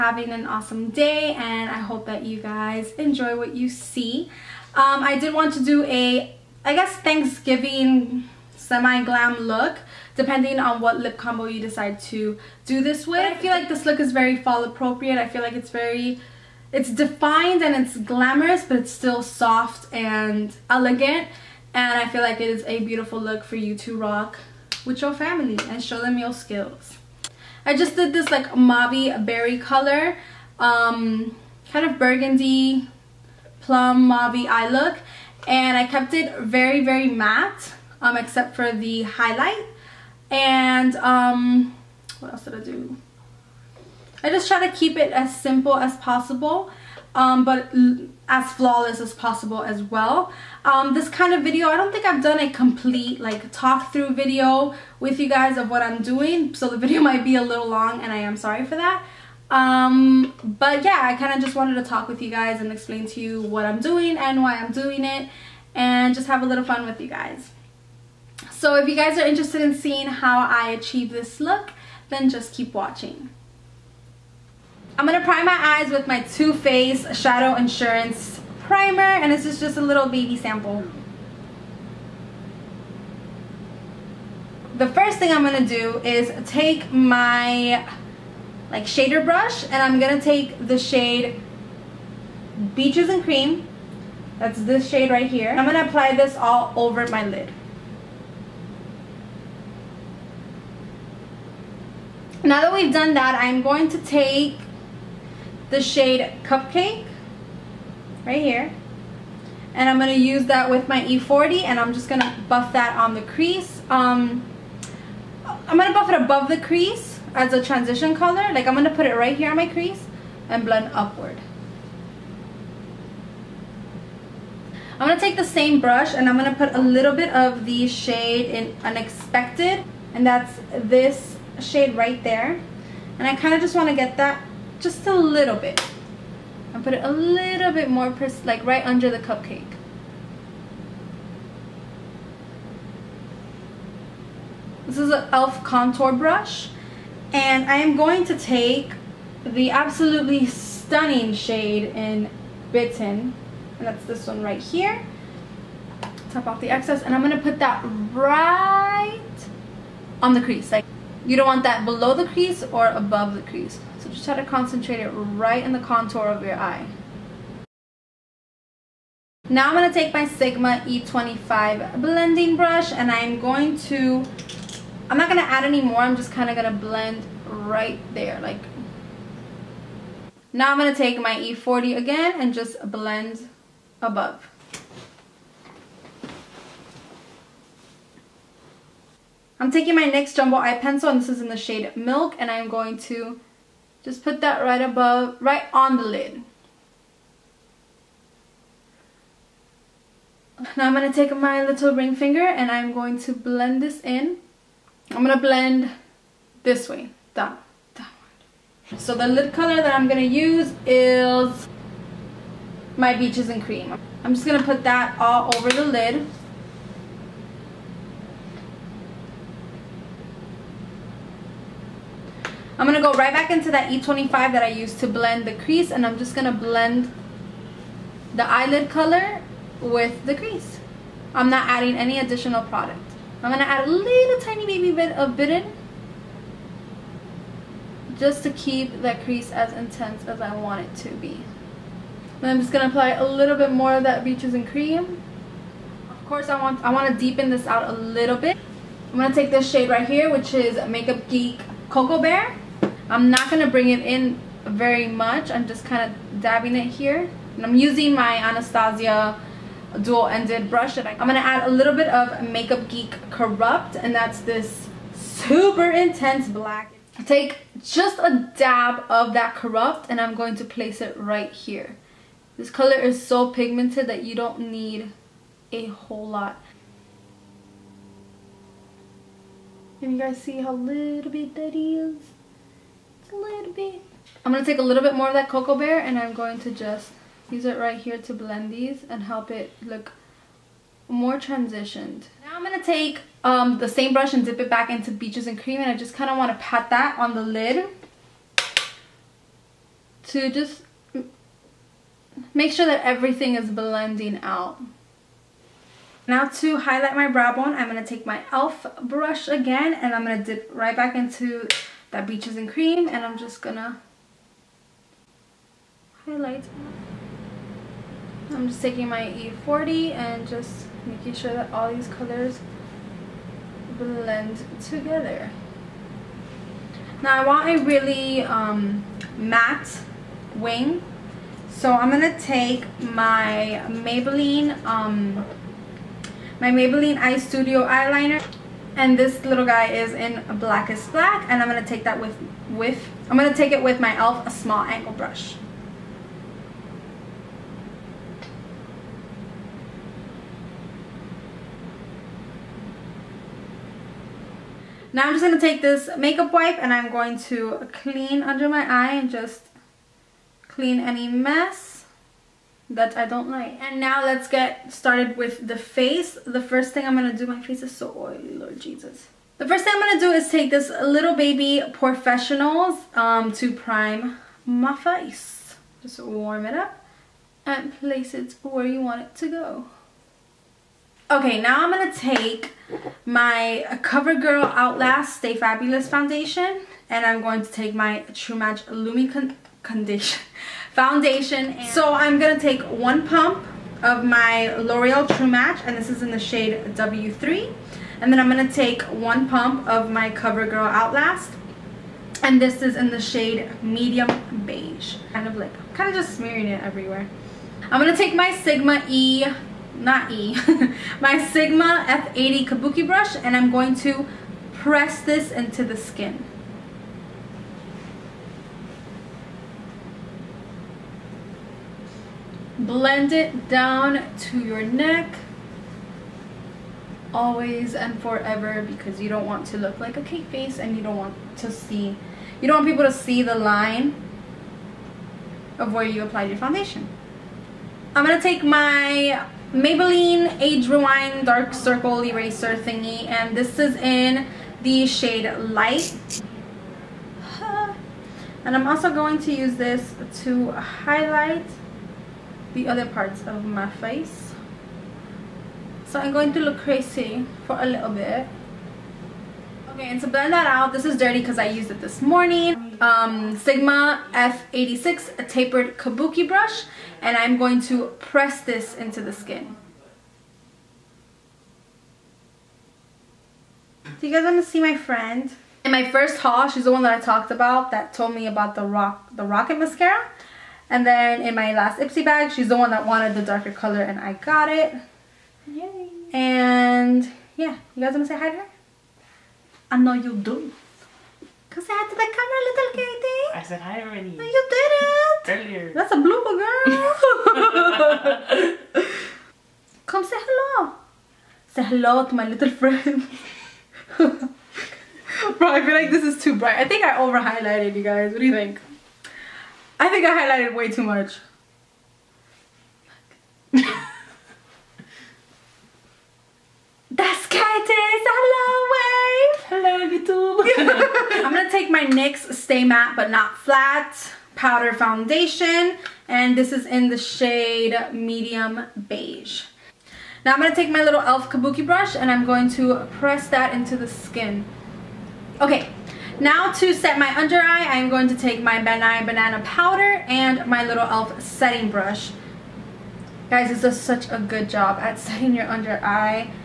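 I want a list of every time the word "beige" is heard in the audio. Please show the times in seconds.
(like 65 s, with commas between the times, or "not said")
404 s, 529 s.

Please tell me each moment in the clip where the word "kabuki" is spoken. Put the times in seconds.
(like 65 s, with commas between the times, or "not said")
412 s, 465 s, 531 s.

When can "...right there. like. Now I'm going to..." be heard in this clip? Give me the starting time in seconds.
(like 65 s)
177 s.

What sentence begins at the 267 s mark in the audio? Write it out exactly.
Take just a dab of that Corrupt and I'm going to place it right here.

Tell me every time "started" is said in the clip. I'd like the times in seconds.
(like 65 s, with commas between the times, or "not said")
364 s.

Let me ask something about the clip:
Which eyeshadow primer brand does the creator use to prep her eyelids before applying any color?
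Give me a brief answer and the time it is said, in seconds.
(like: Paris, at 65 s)
Too Faced Shadow Insurance, at 76 s.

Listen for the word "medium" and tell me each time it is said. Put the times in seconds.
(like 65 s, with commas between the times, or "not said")
403 s, 528 s.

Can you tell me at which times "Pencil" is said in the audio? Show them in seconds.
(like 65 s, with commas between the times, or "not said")
190 s.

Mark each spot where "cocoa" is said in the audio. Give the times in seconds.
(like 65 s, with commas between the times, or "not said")
251 s, 285 s.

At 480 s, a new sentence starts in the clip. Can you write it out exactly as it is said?
And then in my last Ipsy bag, she's the one that wanted the darker color and I got it.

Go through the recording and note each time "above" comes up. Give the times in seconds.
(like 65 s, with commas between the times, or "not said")
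116 s, 162 s, 184 s, 194 s.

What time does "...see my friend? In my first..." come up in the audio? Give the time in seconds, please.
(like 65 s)
474 s.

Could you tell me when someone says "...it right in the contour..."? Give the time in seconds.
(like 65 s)
164 s.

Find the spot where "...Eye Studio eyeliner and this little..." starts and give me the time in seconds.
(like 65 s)
337 s.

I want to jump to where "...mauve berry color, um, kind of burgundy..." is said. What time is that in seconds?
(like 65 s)
28 s.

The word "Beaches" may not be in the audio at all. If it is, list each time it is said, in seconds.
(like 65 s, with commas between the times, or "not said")
92 s, 213 s, 244 s, 295 s, 312 s.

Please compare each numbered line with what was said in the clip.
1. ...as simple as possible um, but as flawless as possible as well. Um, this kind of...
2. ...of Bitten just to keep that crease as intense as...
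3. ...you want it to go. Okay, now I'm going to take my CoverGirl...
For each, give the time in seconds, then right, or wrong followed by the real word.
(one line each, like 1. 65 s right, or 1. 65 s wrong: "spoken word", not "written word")
1. 45 s right
2. 235 s right
3. 378 s right.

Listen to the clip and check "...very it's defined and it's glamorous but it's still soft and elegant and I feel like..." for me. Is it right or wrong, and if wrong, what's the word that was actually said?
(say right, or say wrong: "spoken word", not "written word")
right.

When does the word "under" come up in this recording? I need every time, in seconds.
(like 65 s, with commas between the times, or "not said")
138 s, 358 s, 537 s, 545 s.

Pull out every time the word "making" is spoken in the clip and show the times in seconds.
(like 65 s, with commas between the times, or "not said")
321 s.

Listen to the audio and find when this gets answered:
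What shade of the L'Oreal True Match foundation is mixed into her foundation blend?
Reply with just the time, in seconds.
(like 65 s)
396 s.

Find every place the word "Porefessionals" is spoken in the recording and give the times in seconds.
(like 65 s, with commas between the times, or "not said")
371 s.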